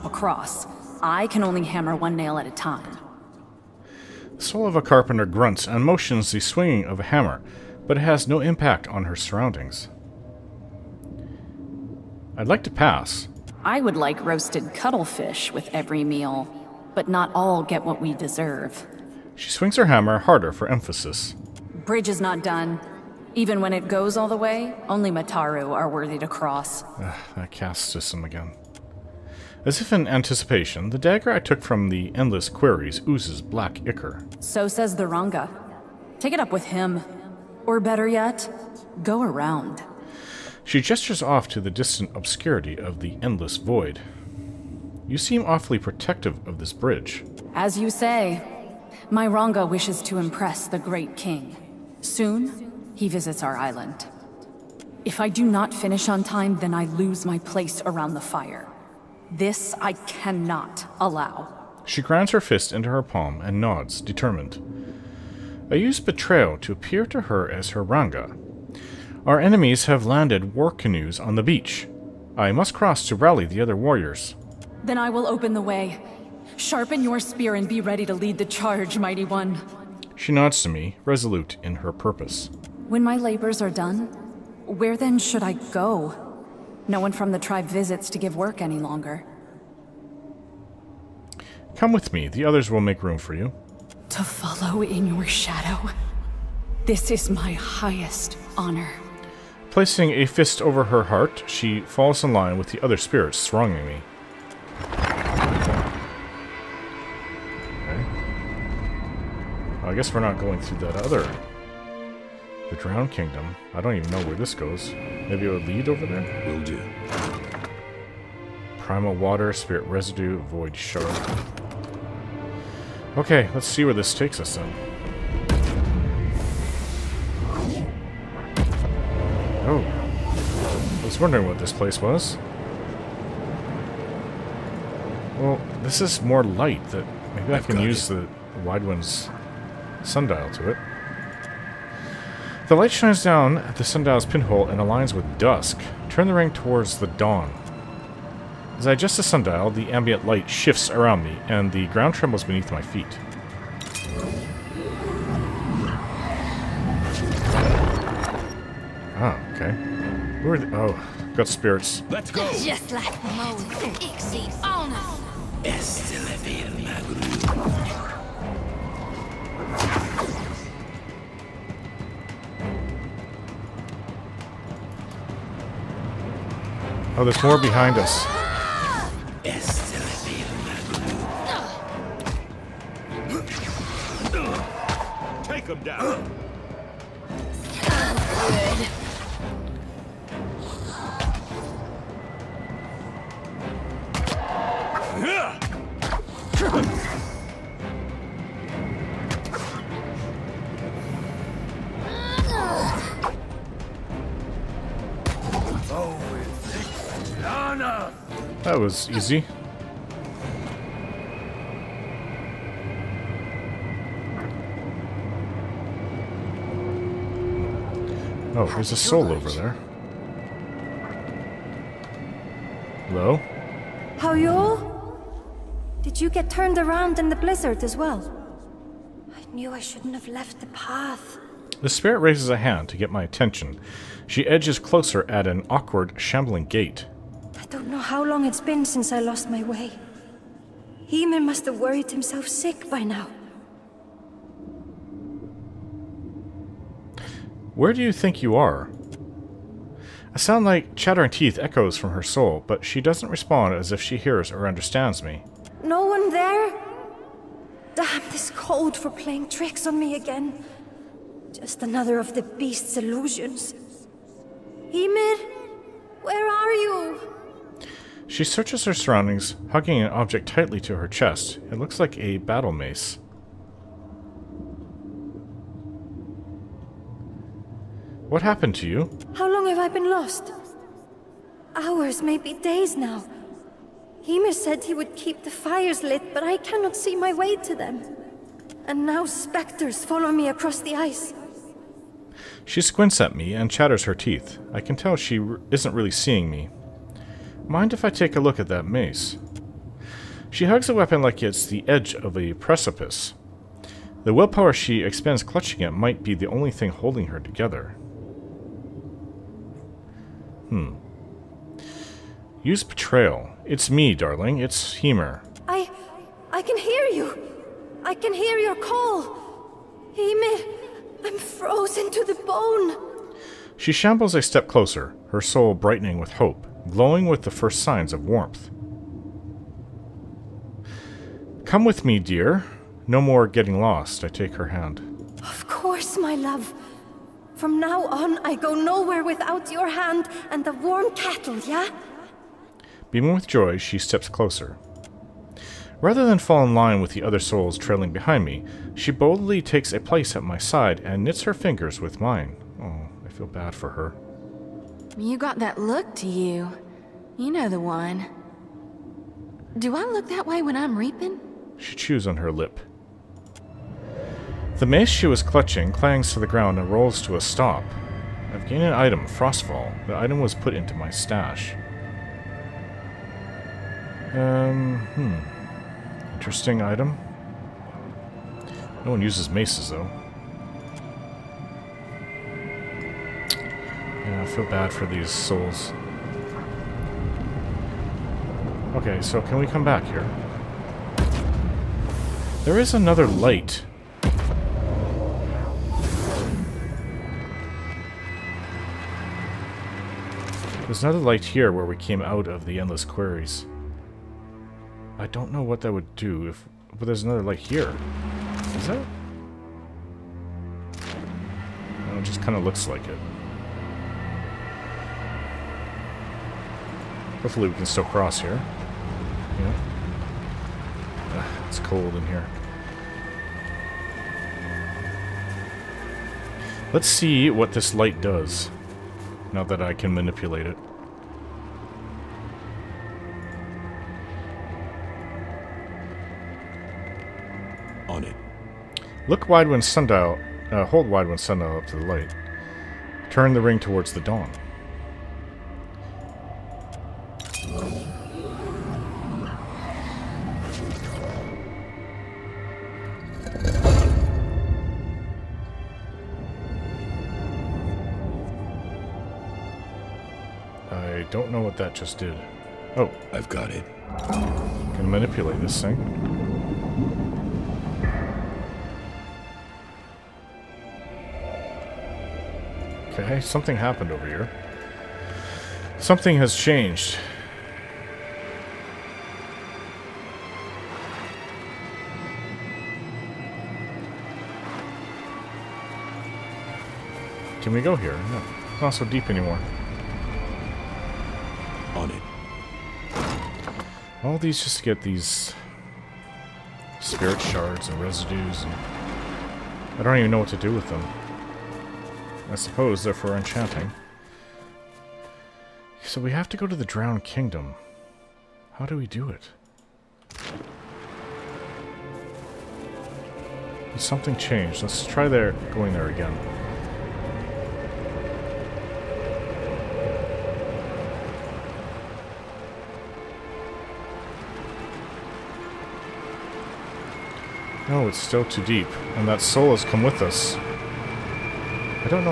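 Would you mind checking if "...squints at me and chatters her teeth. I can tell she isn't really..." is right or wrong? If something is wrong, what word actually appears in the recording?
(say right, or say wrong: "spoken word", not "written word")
right.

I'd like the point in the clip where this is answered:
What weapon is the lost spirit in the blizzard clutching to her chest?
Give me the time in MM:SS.
04:32.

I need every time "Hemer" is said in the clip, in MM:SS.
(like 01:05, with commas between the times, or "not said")
05:14, 05:20.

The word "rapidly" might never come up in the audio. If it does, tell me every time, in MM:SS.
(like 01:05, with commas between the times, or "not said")
not said.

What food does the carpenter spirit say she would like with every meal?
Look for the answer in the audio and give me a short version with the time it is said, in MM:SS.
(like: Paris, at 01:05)
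Roasted cuttlefish, at 00:14.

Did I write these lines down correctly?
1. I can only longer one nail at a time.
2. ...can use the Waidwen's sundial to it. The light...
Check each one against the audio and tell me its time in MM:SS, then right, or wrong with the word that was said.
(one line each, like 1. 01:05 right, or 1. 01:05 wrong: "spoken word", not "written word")
1. 00:01 wrong: "hammer", not "longer"
2. 02:17 right.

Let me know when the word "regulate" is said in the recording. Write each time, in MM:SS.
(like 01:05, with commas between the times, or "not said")
not said.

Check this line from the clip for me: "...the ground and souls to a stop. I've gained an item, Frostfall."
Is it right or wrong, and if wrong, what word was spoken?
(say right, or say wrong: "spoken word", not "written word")
wrong: "rolls", not "souls".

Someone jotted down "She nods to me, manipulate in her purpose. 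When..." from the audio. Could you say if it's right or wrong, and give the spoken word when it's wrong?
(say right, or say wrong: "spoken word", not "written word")
wrong: "resolute", not "manipulate".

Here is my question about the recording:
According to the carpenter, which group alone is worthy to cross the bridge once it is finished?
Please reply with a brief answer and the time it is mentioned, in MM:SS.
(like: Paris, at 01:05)
Mataru, at 00:25.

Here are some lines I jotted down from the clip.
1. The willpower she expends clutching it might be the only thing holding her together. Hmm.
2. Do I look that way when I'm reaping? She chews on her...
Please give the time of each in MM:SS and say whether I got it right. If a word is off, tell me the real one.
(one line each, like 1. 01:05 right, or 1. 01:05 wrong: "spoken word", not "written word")
1. 05:04 right
2. 05:59 right.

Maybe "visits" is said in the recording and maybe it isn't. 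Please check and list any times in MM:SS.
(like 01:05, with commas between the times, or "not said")
00:53, 01:27.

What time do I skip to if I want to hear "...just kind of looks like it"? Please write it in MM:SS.
06:52.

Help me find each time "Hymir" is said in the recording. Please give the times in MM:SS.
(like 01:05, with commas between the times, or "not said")
04:44.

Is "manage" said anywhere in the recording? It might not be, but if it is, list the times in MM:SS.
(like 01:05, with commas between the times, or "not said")
not said.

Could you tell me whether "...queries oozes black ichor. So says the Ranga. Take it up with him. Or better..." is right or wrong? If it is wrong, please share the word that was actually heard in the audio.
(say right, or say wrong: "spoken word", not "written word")
right.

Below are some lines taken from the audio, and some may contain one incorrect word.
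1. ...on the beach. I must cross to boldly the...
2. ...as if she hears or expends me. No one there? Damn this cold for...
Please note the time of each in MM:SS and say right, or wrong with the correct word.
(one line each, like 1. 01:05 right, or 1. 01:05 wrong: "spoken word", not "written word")
1. 01:11 wrong: "rally", not "boldly"
2. 04:13 wrong: "understands", not "expends".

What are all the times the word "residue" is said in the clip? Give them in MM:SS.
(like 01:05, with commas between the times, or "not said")
01:59, 08:18.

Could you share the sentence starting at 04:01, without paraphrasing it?
Hime must have worried himself sick by now.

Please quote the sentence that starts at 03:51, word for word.
The spirit raises a hand to get my attention.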